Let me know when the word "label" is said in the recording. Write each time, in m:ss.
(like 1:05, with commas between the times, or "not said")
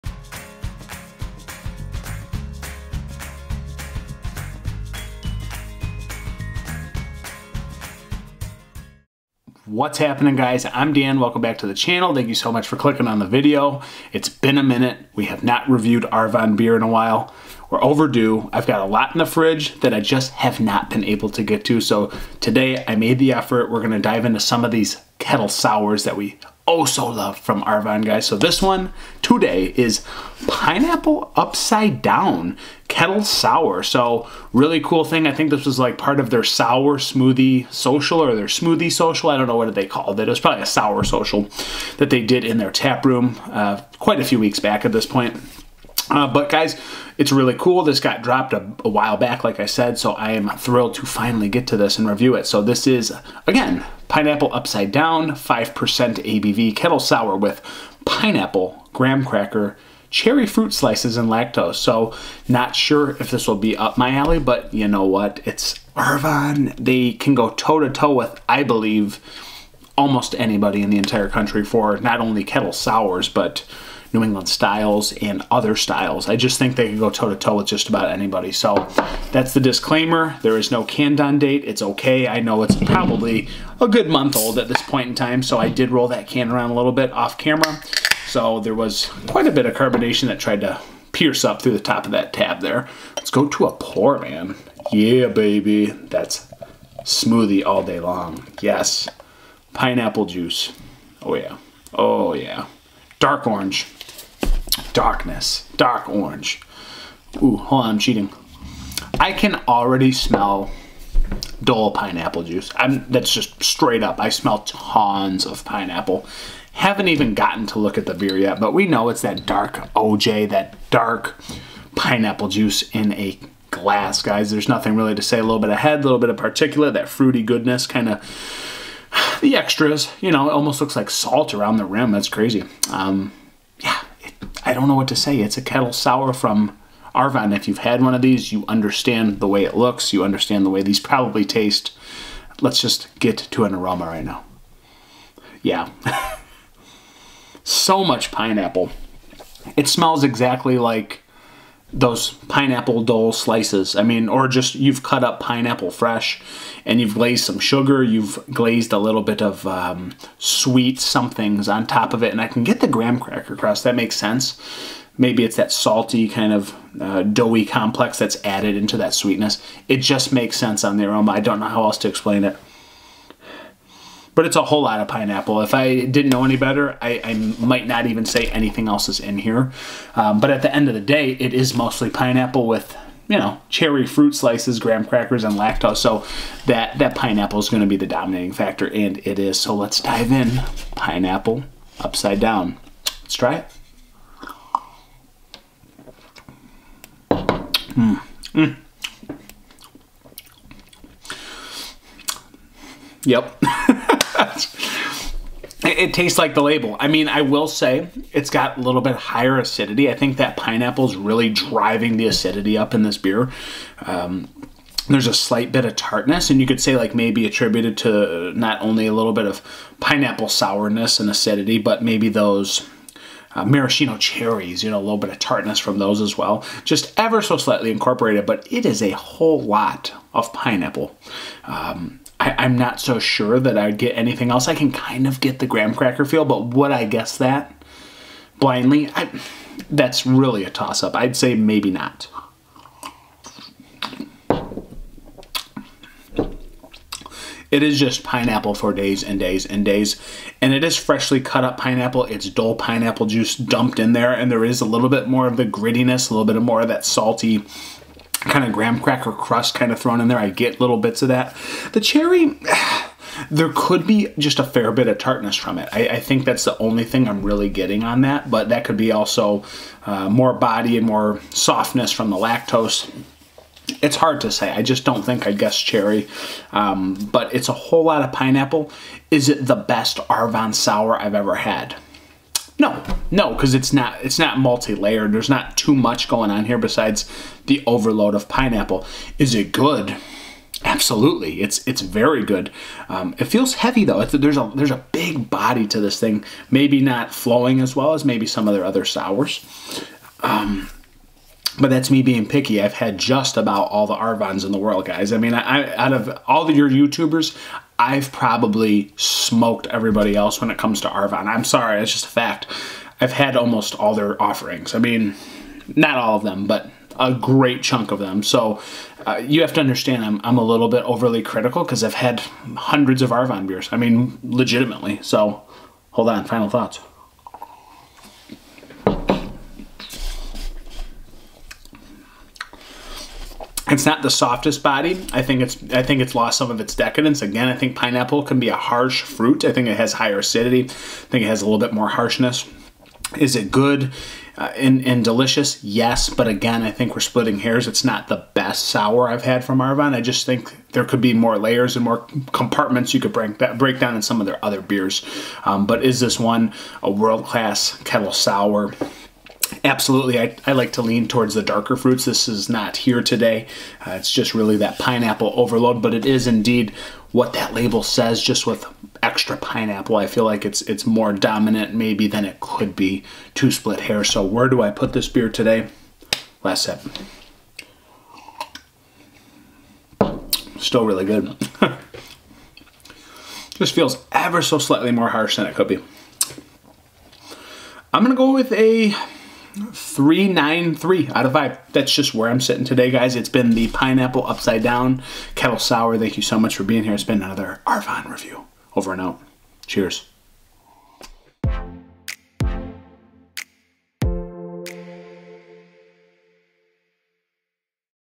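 3:26, 6:07.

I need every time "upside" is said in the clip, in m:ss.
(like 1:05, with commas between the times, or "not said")
0:31, 0:54, 3:11, 6:34.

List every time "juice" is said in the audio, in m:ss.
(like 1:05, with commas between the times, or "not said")
1:40, 1:52, 2:02, 4:13.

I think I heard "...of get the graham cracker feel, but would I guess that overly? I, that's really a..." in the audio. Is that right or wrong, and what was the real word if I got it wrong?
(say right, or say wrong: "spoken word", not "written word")
wrong: "blindly", not "overly".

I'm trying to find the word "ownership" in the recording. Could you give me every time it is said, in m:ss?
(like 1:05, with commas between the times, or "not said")
not said.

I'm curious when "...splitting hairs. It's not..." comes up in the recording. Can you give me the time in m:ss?
5:47.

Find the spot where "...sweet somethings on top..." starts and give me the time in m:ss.
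2:40.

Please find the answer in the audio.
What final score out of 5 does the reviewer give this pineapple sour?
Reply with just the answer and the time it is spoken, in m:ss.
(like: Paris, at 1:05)
3.93, at 6:29.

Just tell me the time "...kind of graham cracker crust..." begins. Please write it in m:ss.
4:18.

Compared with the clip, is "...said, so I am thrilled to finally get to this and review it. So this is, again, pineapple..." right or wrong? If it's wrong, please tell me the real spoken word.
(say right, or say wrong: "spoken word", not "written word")
right.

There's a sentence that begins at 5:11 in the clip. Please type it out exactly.
I'm sorry, it's just a fact.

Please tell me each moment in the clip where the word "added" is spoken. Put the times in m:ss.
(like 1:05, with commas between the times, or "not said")
2:48.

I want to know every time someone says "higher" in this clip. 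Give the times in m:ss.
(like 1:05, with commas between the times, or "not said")
3:29, 5:40.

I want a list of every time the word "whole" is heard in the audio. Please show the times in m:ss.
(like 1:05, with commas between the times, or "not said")
2:54, 3:49, 4:37.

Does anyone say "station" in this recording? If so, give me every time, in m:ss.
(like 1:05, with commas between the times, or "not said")
not said.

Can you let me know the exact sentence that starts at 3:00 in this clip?
Um, but at the end of the day, it is mostly pineapple with you know cherry fruit slices, graham crackers, and lactose.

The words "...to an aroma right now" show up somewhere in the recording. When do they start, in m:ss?
2:23.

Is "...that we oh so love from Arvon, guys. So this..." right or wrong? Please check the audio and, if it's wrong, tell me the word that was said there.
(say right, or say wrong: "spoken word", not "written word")
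right.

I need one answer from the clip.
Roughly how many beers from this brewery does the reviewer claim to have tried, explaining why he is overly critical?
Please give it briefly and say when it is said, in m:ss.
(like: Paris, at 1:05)
hundreds, at 5:22.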